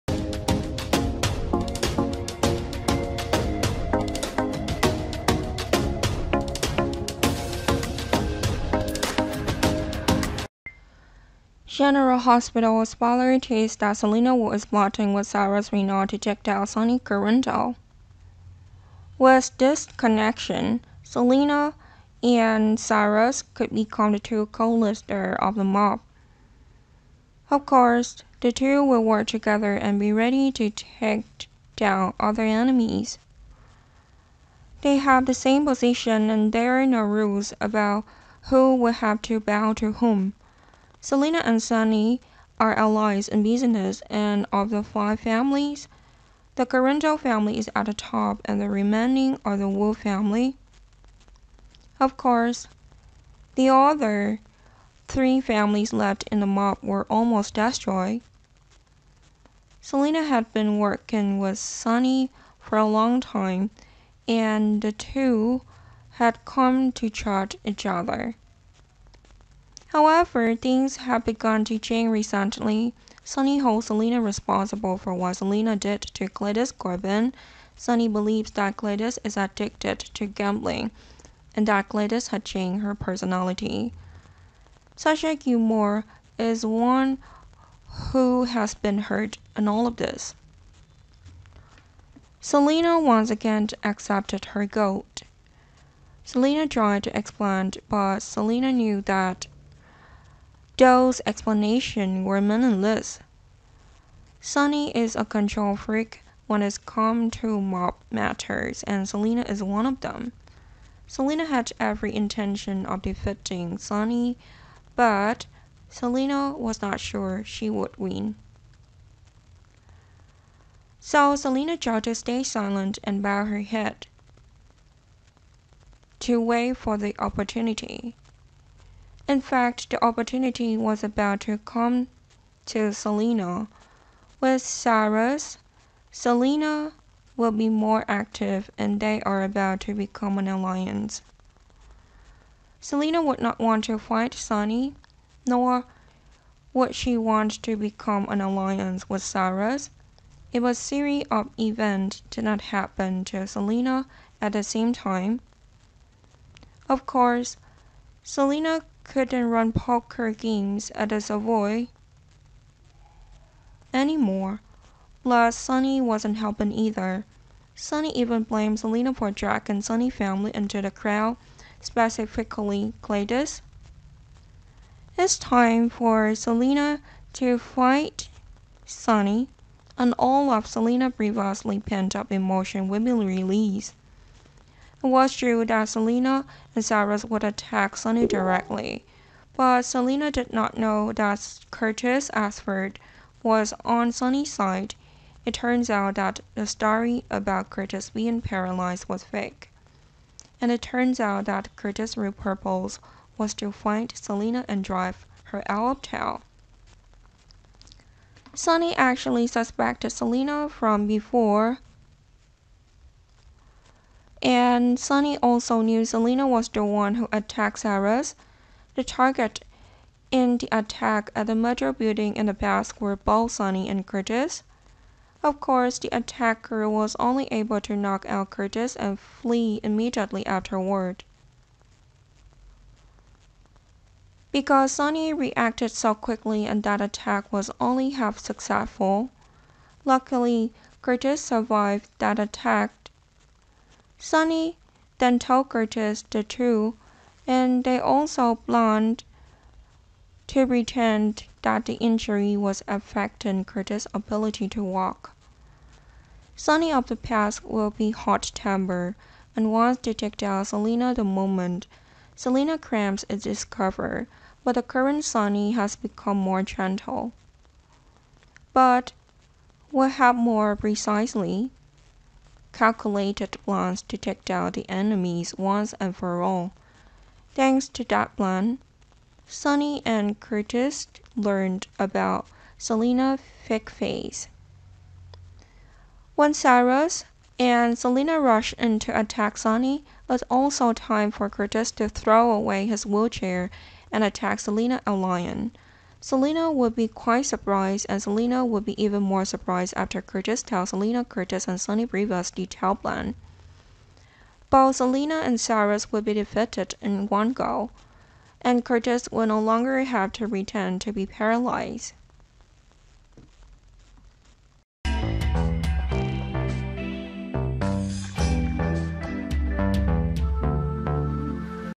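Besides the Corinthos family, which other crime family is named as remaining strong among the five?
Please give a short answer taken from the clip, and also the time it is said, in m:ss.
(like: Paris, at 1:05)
Wu family, at 0:49.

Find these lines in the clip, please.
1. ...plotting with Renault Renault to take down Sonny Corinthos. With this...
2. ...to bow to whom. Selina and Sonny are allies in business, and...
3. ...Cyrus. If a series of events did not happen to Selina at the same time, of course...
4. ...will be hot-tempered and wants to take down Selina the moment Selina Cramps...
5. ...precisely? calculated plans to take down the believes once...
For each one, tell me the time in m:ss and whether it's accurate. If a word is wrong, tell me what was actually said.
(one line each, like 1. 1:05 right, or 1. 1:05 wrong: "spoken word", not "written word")
1. 0:14 wrong: "Cyrus", not "Renault"
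2. 0:39 right
3. 2:29 right
4. 4:17 right
5. 4:30 wrong: "enemies", not "believes".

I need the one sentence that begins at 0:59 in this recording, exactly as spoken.
Selina had been working with Sonny for a long time, and the two had come to trust each other.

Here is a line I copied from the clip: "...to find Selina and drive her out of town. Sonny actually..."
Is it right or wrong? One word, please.
right.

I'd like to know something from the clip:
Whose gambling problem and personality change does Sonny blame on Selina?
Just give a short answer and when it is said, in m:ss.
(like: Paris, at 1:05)
Gladys Corbin, at 1:16.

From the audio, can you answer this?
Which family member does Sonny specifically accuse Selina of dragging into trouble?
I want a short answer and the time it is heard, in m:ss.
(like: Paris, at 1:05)
Cletus, at 2:53.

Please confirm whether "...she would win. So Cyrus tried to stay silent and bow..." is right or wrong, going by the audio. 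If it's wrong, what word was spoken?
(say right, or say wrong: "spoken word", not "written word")
wrong: "Selina", not "Cyrus".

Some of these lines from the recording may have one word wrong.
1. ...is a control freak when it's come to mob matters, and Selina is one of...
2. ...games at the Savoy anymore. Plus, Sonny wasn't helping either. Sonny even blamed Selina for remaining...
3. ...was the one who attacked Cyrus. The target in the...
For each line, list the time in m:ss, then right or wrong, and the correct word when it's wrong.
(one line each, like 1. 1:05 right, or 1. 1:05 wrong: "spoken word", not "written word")
1. 1:44 right
2. 2:40 wrong: "dragging", not "remaining"
3. 3:36 right.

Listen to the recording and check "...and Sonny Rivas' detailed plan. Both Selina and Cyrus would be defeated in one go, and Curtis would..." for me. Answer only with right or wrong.
right.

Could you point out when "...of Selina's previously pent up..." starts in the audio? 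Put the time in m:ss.
3:00.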